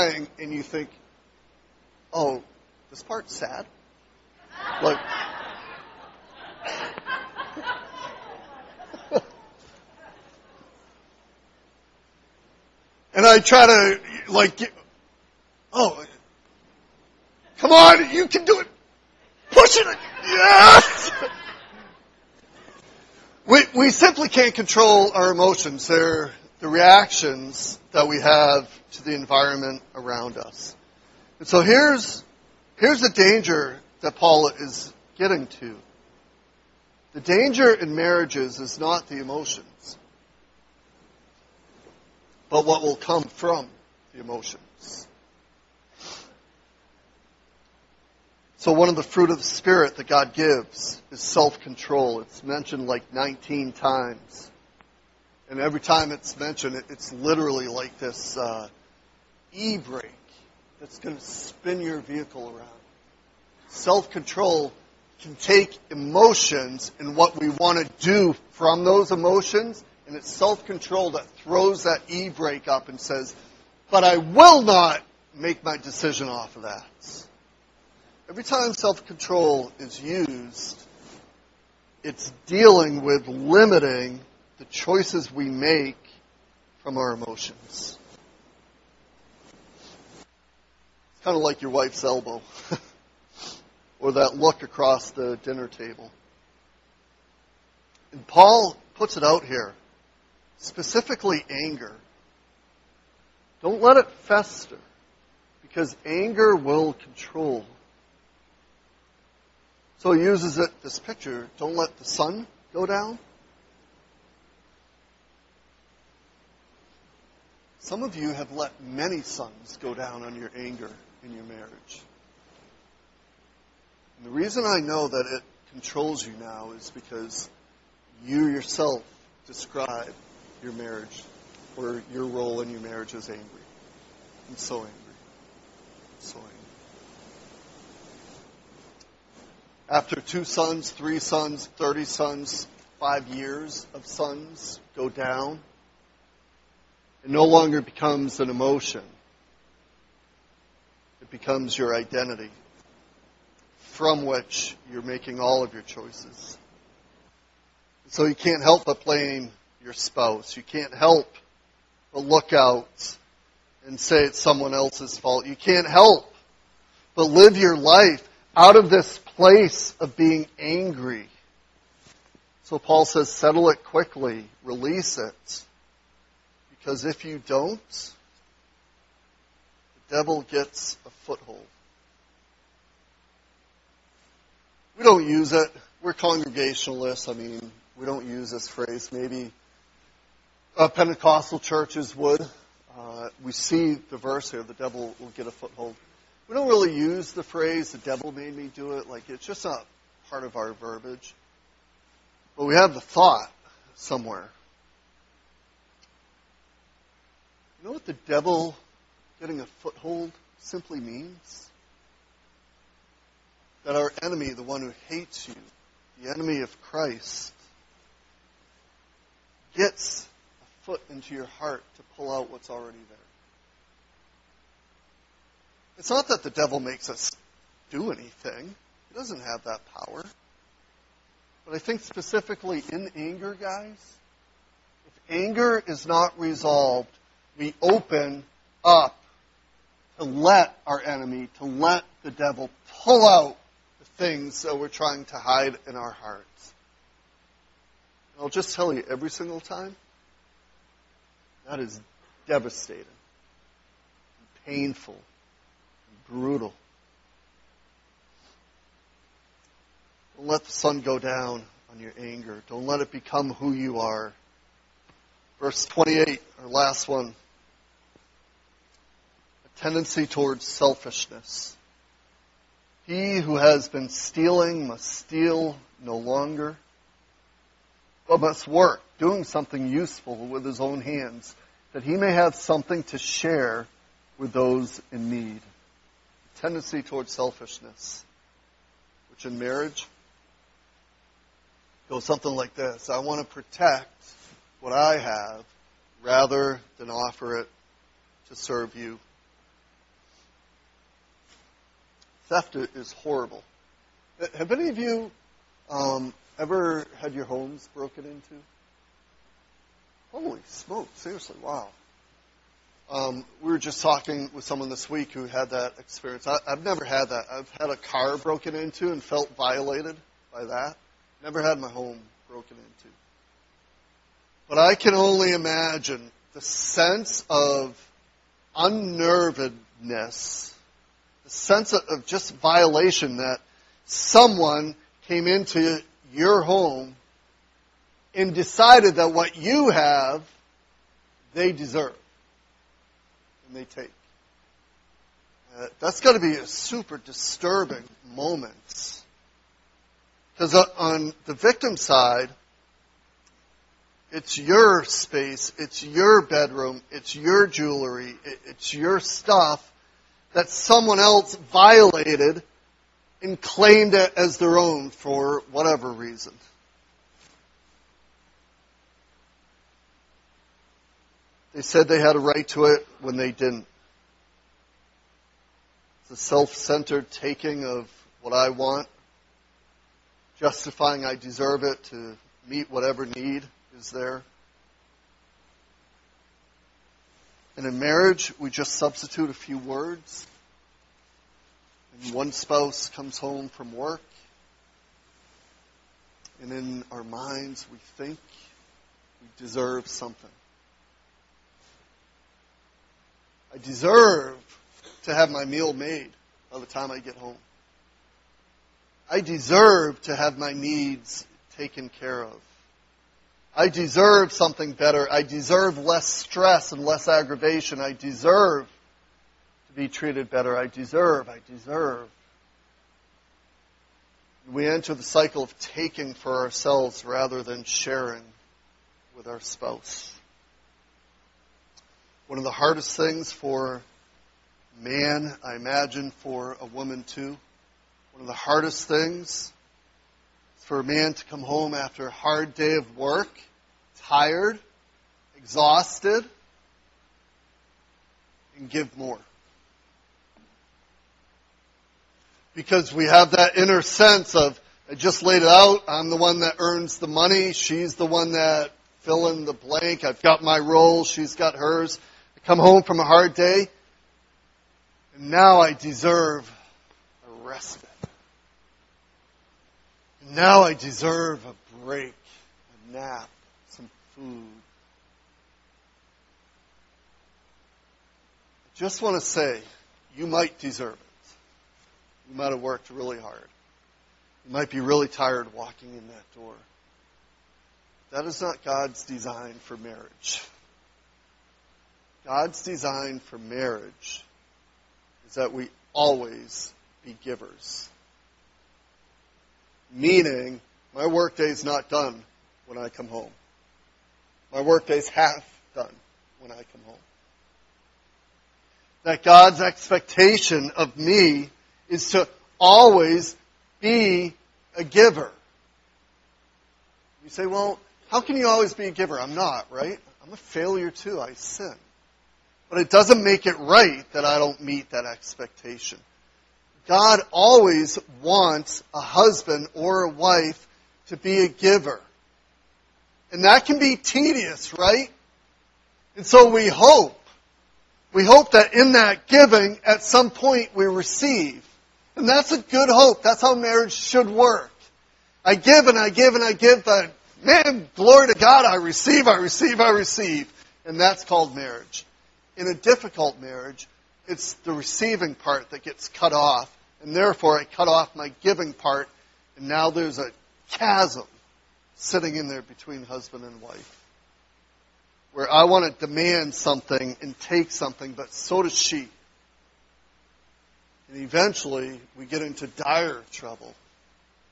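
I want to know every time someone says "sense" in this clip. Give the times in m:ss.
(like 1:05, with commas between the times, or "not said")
5:26, 5:31, 7:34.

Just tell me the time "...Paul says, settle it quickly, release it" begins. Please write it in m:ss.
2:52.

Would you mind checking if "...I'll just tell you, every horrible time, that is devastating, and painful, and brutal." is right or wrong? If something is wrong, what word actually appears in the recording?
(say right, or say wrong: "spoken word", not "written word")
wrong: "single", not "horrible".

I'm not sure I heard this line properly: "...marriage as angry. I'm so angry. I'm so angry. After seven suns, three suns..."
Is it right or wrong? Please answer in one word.
wrong.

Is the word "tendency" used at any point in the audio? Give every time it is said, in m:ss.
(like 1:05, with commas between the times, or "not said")
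4:29, 4:46.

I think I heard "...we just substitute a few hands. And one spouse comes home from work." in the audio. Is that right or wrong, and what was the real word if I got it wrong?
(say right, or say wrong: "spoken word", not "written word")
wrong: "words", not "hands".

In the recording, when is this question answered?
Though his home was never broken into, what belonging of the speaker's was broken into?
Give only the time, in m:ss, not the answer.
5:17.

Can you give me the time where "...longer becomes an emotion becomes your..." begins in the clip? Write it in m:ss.
2:27.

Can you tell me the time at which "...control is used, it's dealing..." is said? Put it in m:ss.
1:19.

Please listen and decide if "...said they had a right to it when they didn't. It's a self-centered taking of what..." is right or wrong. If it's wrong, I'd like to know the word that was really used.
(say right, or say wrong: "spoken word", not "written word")
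right.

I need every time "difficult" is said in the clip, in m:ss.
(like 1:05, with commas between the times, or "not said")
9:12.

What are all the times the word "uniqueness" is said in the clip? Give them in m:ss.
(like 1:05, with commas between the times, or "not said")
not said.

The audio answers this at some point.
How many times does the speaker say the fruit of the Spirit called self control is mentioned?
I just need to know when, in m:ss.
0:53.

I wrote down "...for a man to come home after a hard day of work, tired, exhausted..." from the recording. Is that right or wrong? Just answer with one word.
right.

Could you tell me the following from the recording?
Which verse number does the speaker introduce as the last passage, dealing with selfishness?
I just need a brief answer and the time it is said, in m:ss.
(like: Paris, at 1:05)
28, at 4:25.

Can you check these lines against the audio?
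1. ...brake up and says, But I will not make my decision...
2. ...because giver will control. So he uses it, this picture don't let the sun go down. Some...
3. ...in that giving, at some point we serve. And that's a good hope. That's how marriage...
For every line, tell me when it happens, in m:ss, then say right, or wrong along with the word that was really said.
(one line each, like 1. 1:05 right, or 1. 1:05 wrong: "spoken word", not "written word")
1. 1:12 right
2. 1:45 wrong: "anger", not "giver"
3. 8:58 wrong: "receive", not "serve".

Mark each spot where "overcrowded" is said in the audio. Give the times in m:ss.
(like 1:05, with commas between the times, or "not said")
not said.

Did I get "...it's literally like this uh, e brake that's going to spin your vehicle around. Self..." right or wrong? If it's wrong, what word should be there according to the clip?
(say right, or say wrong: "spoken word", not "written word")
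right.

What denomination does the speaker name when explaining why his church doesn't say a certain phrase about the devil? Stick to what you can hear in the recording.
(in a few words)
Congregationalists.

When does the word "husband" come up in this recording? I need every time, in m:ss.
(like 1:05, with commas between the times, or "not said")
8:49, 9:23.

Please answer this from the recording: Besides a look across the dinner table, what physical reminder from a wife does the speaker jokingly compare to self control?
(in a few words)
Your wife's elbow.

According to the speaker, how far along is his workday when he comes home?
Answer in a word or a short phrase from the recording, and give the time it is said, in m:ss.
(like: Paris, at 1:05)
Half done, at 8:25.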